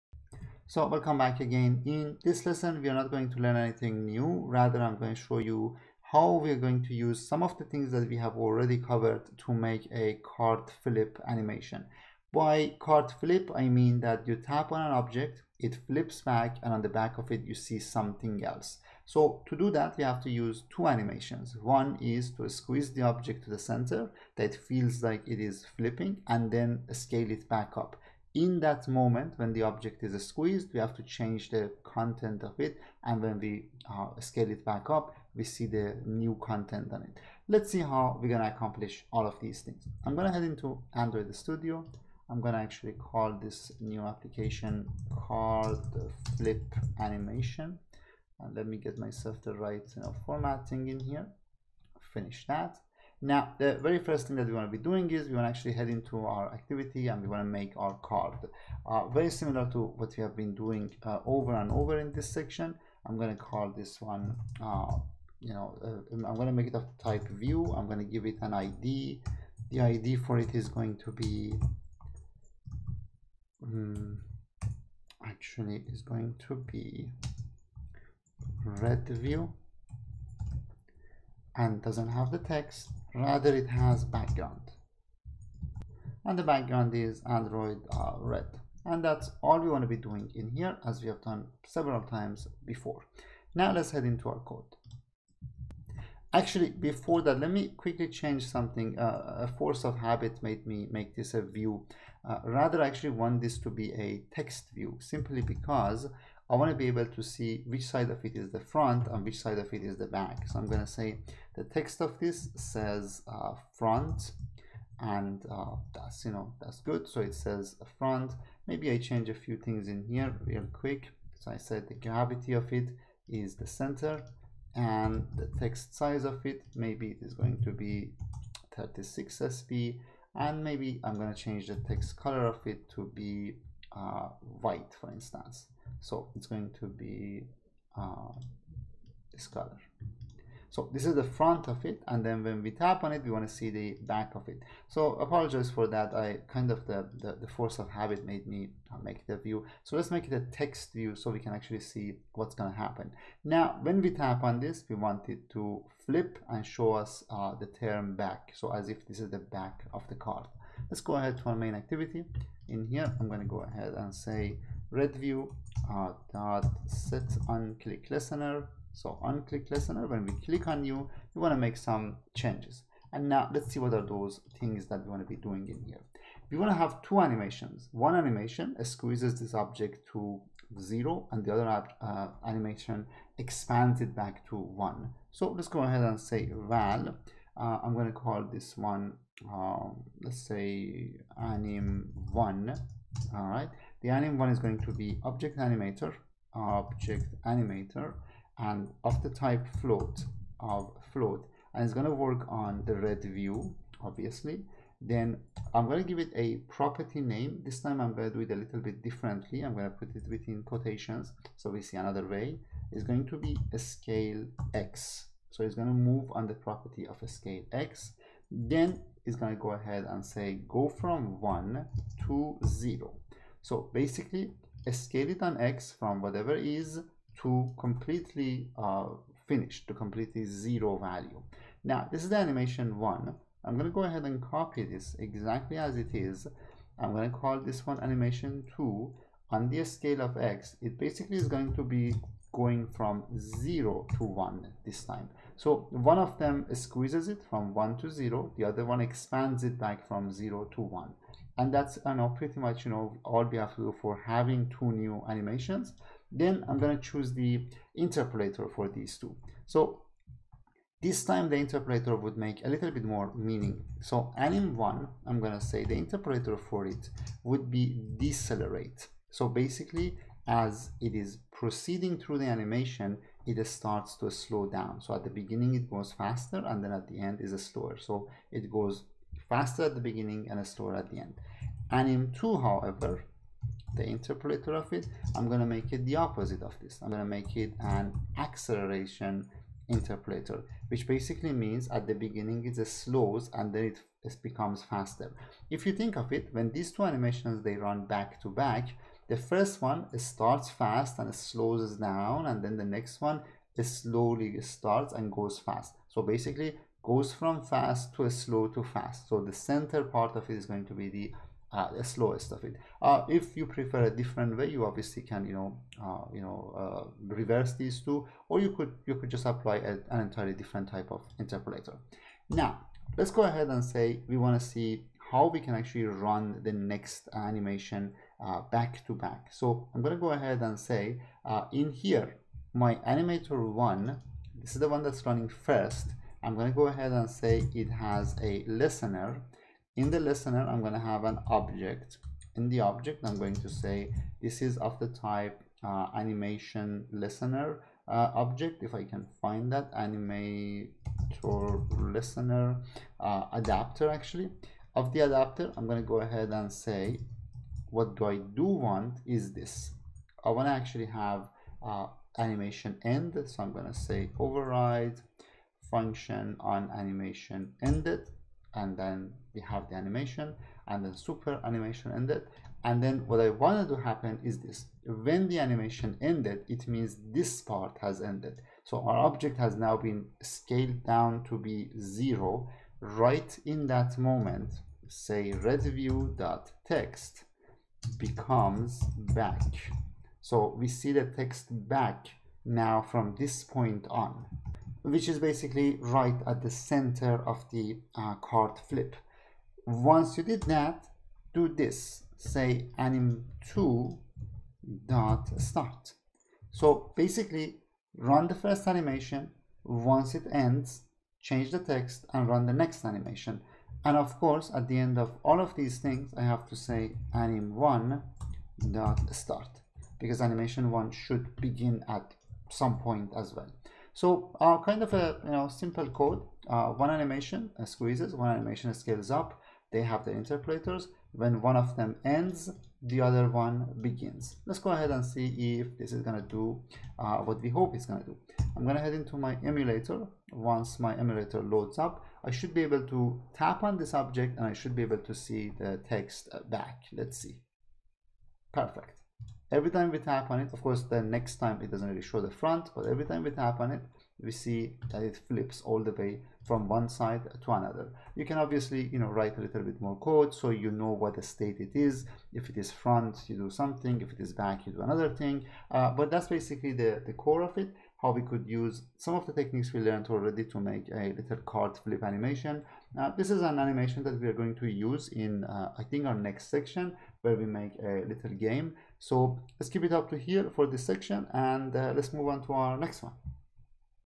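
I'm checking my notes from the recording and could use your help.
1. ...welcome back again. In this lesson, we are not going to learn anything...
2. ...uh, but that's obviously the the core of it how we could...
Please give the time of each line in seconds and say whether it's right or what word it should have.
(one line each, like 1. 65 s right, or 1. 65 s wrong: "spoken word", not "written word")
1. 0 s right
2. 465 s wrong: "basically", not "obviously".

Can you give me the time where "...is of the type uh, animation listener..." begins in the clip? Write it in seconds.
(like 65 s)
344 s.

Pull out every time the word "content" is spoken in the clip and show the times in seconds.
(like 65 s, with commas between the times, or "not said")
31 s, 36 s.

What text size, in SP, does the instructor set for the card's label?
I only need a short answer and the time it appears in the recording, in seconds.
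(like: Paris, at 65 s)
36, at 128 s.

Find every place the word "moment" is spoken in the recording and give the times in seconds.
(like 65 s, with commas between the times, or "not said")
28 s, 384 s.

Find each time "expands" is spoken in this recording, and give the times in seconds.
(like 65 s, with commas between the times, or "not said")
183 s, 249 s.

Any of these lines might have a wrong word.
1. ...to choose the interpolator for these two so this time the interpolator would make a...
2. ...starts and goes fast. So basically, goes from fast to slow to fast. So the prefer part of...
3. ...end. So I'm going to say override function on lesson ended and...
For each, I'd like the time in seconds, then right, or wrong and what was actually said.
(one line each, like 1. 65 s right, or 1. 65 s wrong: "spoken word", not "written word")
1. 256 s right
2. 304 s wrong: "center", not "prefer"
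3. 363 s wrong: "animation", not "lesson".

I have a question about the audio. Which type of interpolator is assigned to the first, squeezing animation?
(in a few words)
decelerate.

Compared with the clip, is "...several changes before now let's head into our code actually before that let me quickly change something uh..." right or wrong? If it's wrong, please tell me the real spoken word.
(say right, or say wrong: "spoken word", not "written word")
wrong: "times", not "changes".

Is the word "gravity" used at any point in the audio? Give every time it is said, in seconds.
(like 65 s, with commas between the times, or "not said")
121 s.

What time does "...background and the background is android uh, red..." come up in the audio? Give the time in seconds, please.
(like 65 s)
84 s.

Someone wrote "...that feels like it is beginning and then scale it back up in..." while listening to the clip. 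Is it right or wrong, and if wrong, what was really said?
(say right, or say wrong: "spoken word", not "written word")
wrong: "flipping", not "beginning".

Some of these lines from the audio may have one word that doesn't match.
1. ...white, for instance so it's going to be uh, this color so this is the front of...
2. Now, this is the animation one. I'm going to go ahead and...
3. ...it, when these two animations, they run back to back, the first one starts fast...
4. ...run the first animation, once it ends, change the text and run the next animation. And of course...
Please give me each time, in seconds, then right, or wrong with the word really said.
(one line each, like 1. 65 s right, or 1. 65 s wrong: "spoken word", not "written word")
1. 134 s right
2. 231 s right
3. 296 s right
4. 408 s right.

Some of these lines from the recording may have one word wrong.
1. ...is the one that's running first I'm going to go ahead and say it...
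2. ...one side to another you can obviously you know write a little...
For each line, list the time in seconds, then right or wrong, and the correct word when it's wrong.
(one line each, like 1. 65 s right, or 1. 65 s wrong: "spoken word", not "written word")
1. 334 s right
2. 456 s right.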